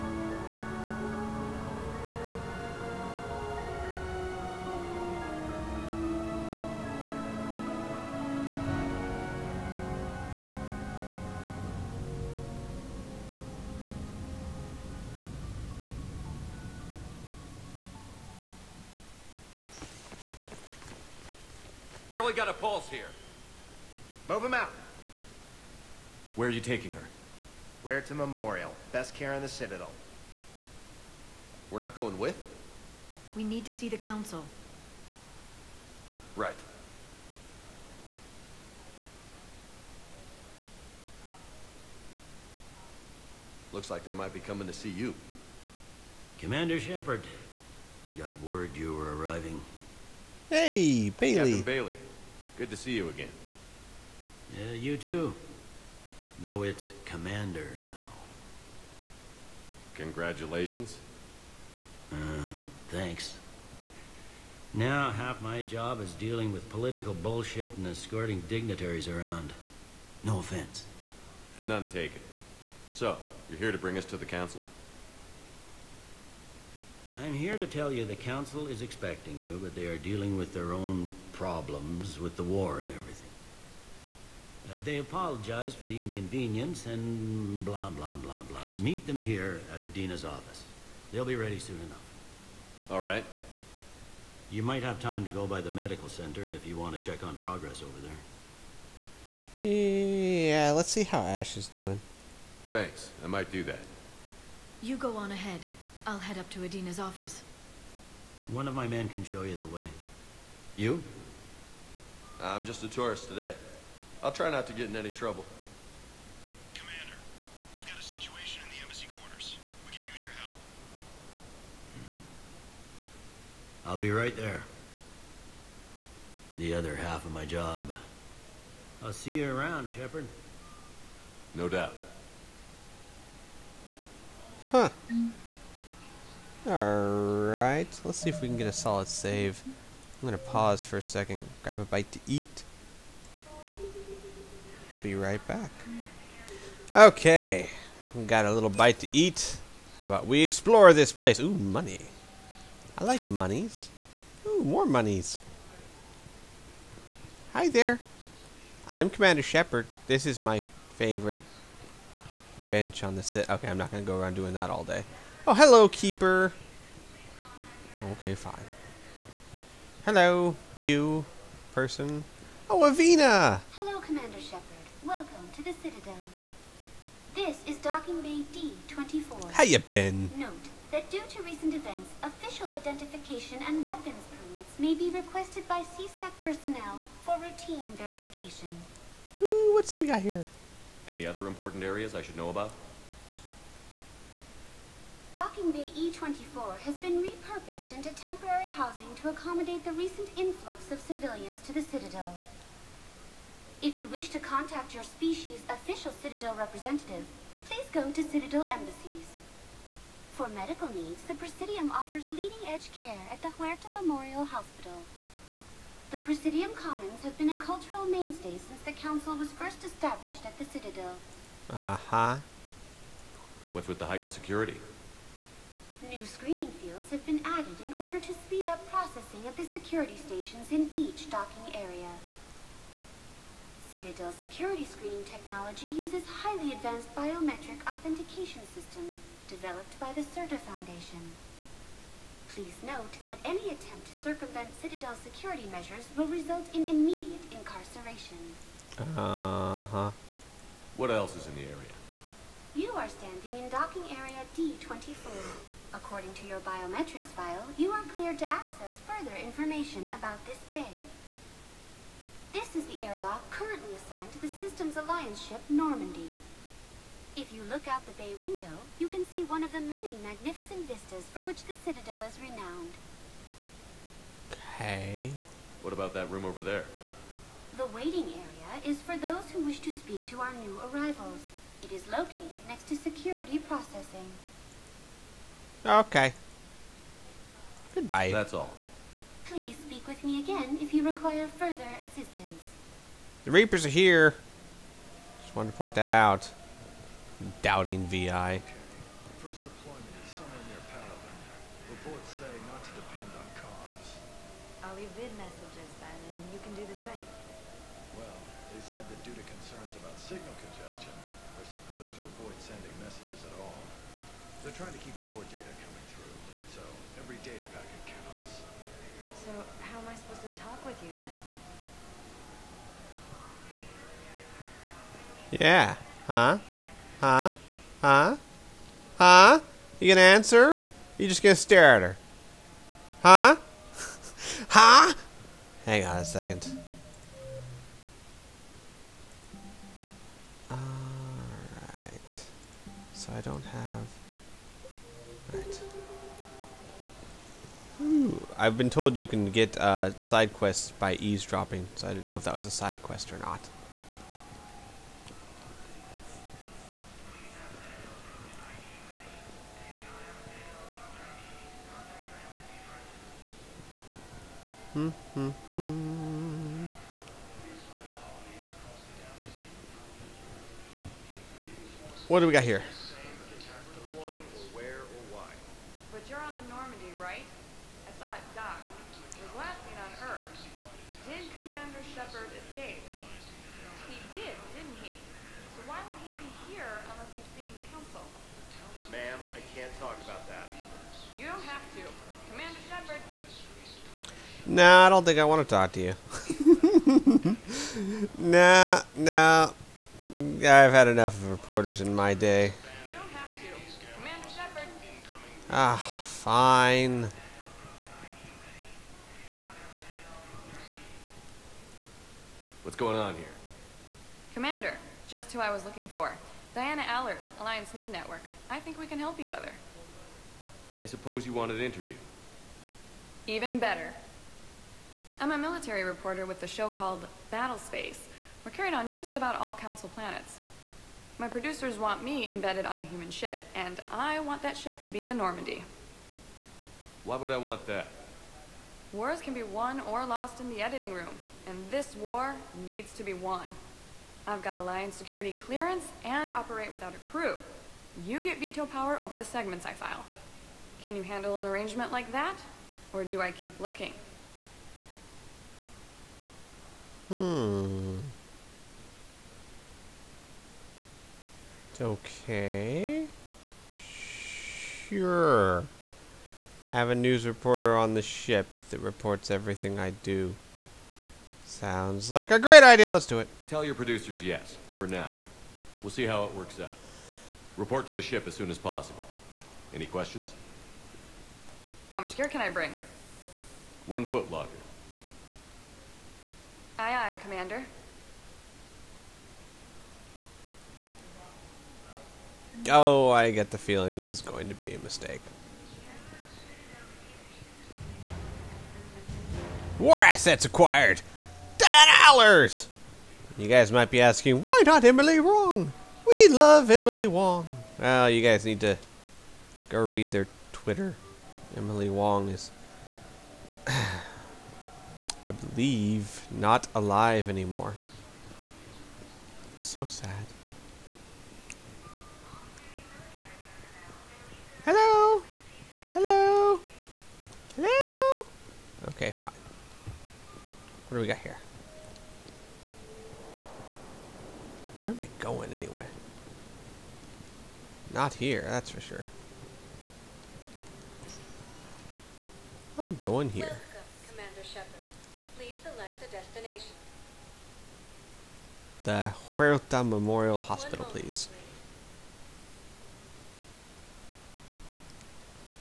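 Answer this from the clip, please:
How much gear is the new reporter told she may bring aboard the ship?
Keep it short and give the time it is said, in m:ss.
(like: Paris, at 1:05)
One foot locker, at 8:04.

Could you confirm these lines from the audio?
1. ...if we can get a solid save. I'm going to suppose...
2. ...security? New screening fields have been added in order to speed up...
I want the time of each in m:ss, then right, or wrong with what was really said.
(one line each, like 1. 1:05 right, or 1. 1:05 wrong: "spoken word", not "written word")
1. 2:18 wrong: "pause", not "suppose"
2. 3:44 right.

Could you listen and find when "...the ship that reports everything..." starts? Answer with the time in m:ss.
7:48.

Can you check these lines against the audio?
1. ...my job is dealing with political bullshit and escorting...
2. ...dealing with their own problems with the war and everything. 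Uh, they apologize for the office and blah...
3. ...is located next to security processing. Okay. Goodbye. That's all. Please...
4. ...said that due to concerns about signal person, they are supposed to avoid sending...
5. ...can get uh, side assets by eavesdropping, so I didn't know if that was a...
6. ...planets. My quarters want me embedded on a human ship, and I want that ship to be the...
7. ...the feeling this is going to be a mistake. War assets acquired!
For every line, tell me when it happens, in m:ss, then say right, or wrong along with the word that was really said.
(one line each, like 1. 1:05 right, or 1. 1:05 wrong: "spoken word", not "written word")
1. 1:05 right
2. 1:19 wrong: "inconvenience", not "office"
3. 4:41 right
4. 5:08 wrong: "congestion", not "person"
5. 5:49 wrong: "quests", not "assets"
6. 7:10 wrong: "producers", not "quarters"
7. 8:13 right.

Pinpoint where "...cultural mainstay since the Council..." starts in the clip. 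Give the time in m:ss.
3:37.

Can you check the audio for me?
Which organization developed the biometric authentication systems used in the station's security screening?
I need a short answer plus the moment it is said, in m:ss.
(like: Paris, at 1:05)
Sirta Foundation, at 4:00.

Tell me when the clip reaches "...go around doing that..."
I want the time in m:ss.
2:44.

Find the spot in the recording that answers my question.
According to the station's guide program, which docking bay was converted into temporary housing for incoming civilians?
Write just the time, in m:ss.
3:15.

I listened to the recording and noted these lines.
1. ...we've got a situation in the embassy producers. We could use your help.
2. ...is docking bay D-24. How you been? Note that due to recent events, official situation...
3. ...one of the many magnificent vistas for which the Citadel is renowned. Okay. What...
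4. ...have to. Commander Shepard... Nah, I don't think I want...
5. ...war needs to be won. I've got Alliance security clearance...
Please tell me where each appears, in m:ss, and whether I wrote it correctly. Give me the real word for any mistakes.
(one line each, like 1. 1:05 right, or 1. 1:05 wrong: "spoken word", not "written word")
1. 1:57 wrong: "quarters", not "producers"
2. 2:57 wrong: "identification", not "situation"
3. 4:29 right
4. 6:31 right
5. 7:22 right.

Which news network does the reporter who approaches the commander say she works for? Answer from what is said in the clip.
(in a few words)
Alliance News Network.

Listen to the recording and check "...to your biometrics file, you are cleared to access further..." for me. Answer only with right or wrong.
right.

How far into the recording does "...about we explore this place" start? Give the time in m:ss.
2:30.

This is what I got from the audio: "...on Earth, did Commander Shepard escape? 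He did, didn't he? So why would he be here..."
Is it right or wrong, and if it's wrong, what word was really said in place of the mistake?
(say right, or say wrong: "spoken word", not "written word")
right.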